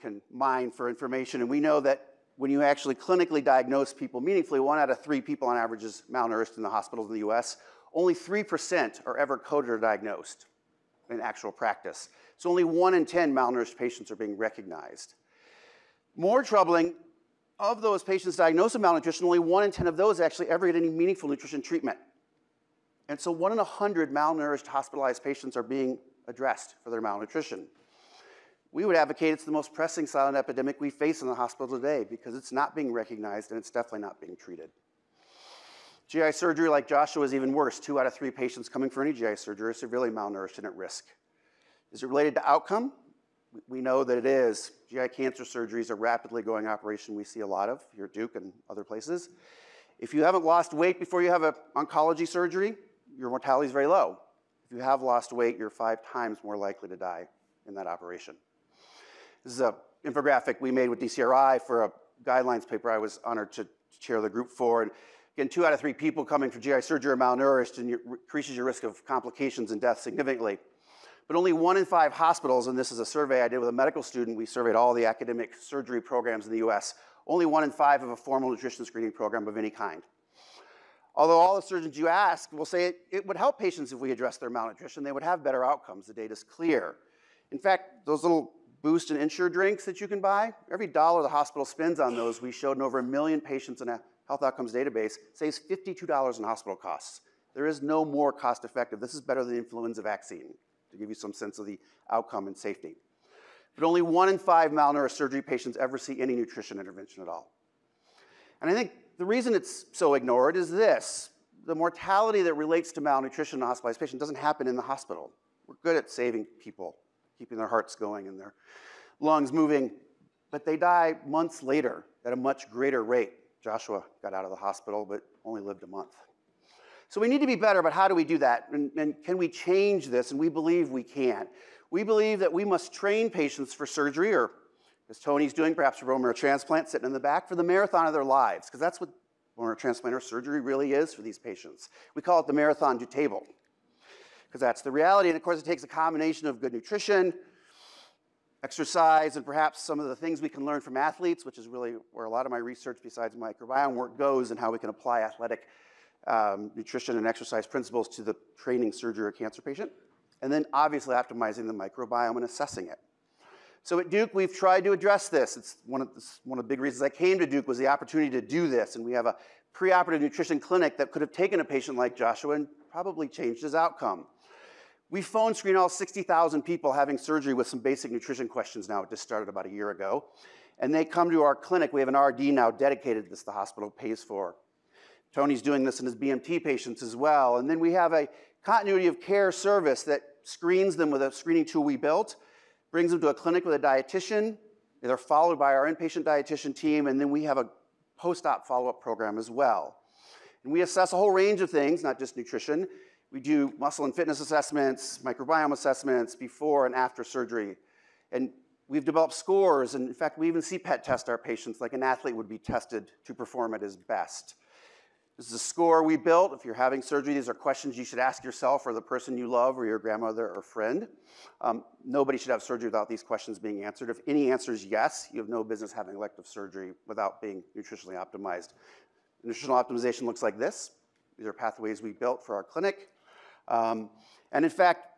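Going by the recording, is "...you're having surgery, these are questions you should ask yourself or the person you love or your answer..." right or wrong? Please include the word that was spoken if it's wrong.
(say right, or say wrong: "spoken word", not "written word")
wrong: "grandmother", not "answer".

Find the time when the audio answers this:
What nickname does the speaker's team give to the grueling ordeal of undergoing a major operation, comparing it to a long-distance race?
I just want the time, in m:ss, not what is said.
2:22.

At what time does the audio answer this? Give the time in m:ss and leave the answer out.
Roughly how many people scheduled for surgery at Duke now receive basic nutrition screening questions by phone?
2:55.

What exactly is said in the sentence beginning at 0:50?
If you haven't lost weight before you have an oncology surgery, your mortality is very low.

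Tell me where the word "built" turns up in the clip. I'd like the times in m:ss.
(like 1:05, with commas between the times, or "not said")
3:11, 3:36, 3:52.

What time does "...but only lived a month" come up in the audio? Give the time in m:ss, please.
2:05.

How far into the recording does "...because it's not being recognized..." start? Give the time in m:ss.
0:32.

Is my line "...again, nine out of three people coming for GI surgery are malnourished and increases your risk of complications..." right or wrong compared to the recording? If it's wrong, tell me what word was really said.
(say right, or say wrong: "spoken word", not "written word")
wrong: "two", not "nine".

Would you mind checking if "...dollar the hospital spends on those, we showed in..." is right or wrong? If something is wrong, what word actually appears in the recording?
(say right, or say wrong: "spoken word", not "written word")
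right.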